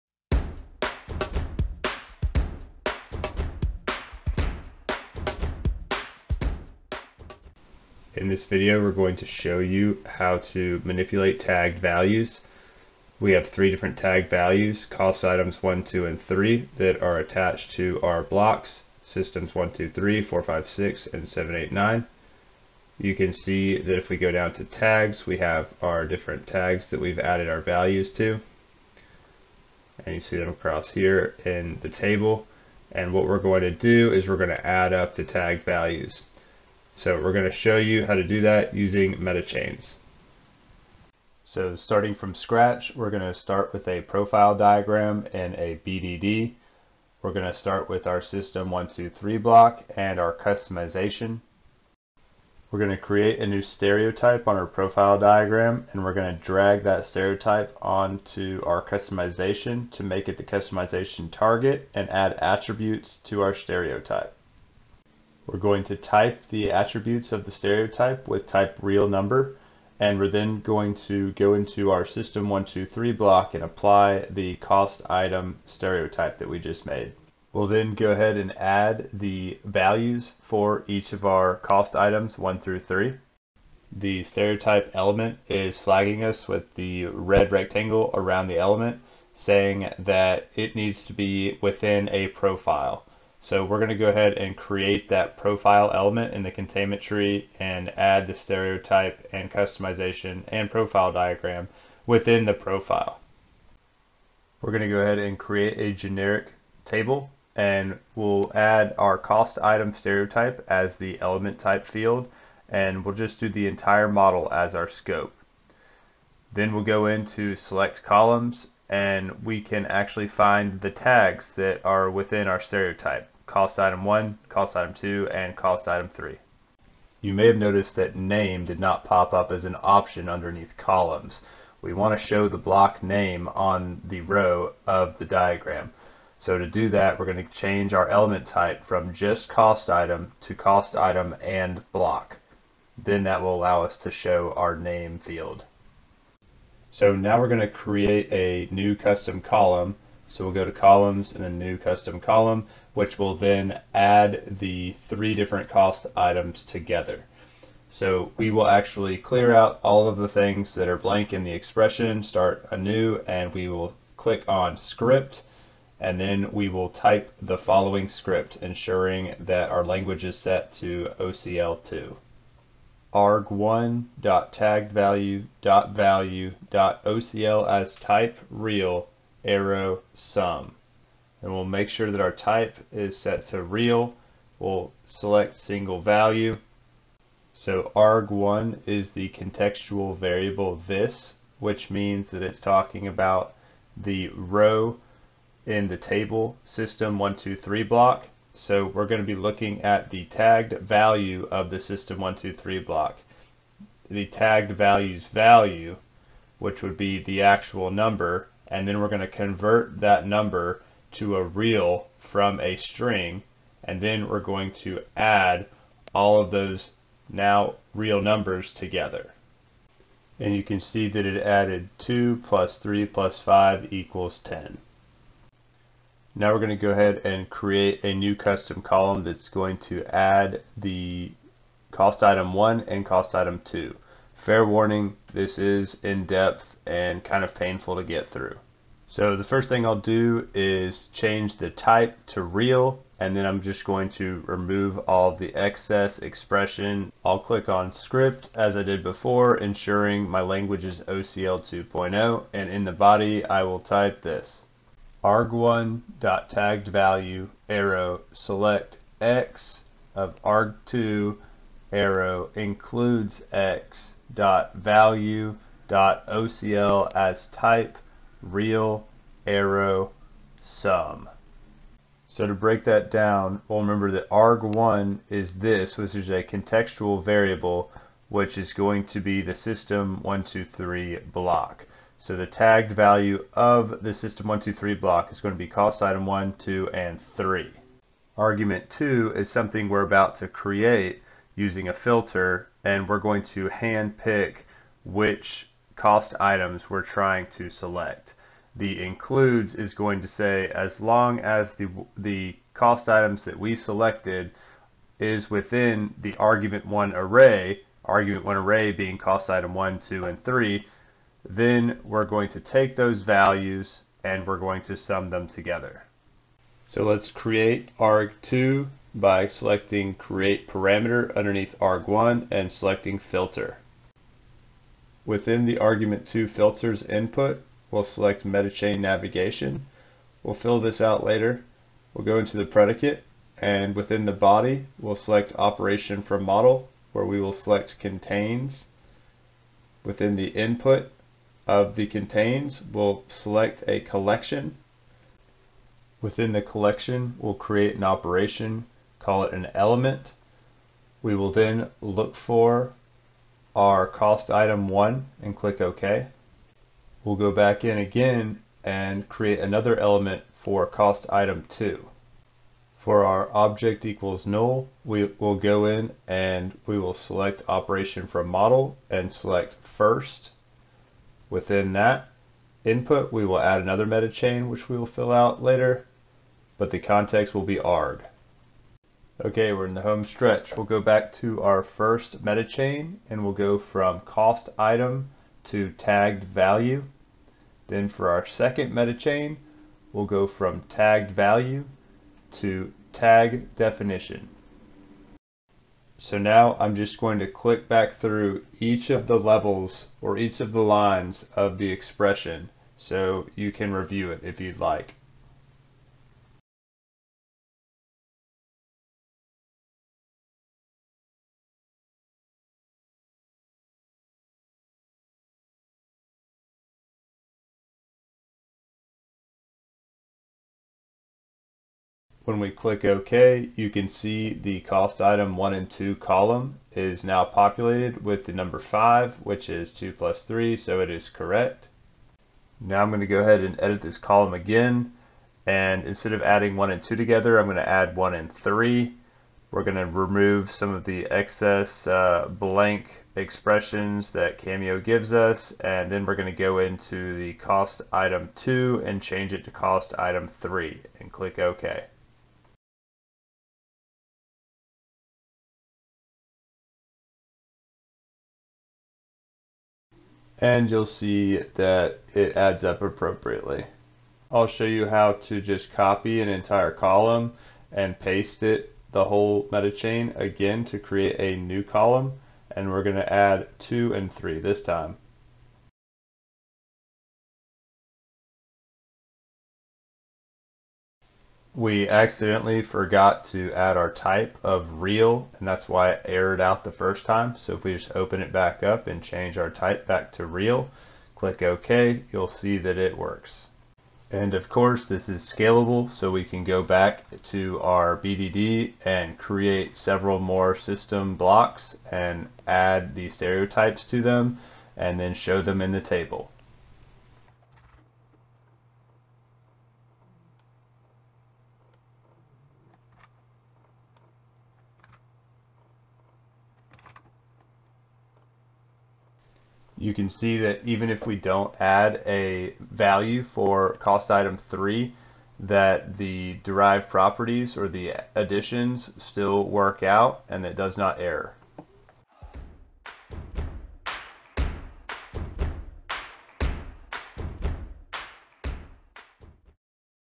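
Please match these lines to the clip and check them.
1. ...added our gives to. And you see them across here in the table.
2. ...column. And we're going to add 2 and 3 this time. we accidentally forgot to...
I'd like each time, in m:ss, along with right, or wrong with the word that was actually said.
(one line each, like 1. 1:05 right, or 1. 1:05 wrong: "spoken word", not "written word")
1. 0:27 wrong: "values", not "gives"
2. 7:51 right.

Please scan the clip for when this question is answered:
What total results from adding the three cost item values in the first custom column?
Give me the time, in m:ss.
3:44.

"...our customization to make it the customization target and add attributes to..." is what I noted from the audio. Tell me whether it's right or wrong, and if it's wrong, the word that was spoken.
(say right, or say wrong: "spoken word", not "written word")
right.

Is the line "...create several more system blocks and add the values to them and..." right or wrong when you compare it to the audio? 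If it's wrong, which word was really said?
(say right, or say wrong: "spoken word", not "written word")
wrong: "stereotypes", not "values".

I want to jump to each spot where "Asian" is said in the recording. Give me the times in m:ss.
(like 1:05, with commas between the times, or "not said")
not said.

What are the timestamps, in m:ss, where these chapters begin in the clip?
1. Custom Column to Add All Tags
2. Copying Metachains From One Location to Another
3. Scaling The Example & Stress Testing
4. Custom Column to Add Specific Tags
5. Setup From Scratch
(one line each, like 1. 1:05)
1. 2:29
2. 7:44
3. 8:13
4. 3:45
5. 0:40.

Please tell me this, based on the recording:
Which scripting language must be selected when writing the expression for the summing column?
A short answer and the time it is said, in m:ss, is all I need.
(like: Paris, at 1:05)
OCL2, at 2:51.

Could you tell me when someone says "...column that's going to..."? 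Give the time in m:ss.
3:48.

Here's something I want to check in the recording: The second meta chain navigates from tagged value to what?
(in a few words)
tag definition.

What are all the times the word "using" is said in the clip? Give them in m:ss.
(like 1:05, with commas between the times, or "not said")
0:38, 4:51.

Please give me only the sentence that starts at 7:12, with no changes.
Now I'm going to go ahead and edit this column again.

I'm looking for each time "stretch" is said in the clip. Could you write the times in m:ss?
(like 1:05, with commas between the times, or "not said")
6:20.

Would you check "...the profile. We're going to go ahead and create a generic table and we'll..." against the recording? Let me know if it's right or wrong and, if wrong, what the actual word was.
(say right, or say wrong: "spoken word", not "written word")
right.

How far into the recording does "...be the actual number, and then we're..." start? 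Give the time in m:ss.
3:26.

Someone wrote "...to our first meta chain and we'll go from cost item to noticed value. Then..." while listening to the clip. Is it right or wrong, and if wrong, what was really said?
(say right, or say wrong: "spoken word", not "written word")
wrong: "tagged", not "noticed".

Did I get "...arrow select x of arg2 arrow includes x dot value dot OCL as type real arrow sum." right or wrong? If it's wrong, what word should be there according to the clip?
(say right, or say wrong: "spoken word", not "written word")
right.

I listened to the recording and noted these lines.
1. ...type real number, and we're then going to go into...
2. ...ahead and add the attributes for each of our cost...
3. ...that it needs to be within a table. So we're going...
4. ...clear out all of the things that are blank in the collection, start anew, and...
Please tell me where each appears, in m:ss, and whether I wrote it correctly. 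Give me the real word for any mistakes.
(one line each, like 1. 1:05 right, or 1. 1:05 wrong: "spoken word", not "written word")
1. 1:08 right
2. 1:18 wrong: "values", not "attributes"
3. 1:29 wrong: "profile", not "table"
4. 2:39 wrong: "expression", not "collection".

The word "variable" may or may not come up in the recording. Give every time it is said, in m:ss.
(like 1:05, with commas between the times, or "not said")
3:10, 4:37.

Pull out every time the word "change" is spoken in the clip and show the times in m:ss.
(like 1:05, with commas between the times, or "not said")
2:17, 4:01, 7:29, 8:09.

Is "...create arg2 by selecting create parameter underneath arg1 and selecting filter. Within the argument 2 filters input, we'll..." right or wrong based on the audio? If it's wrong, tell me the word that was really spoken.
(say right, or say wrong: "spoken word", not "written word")
right.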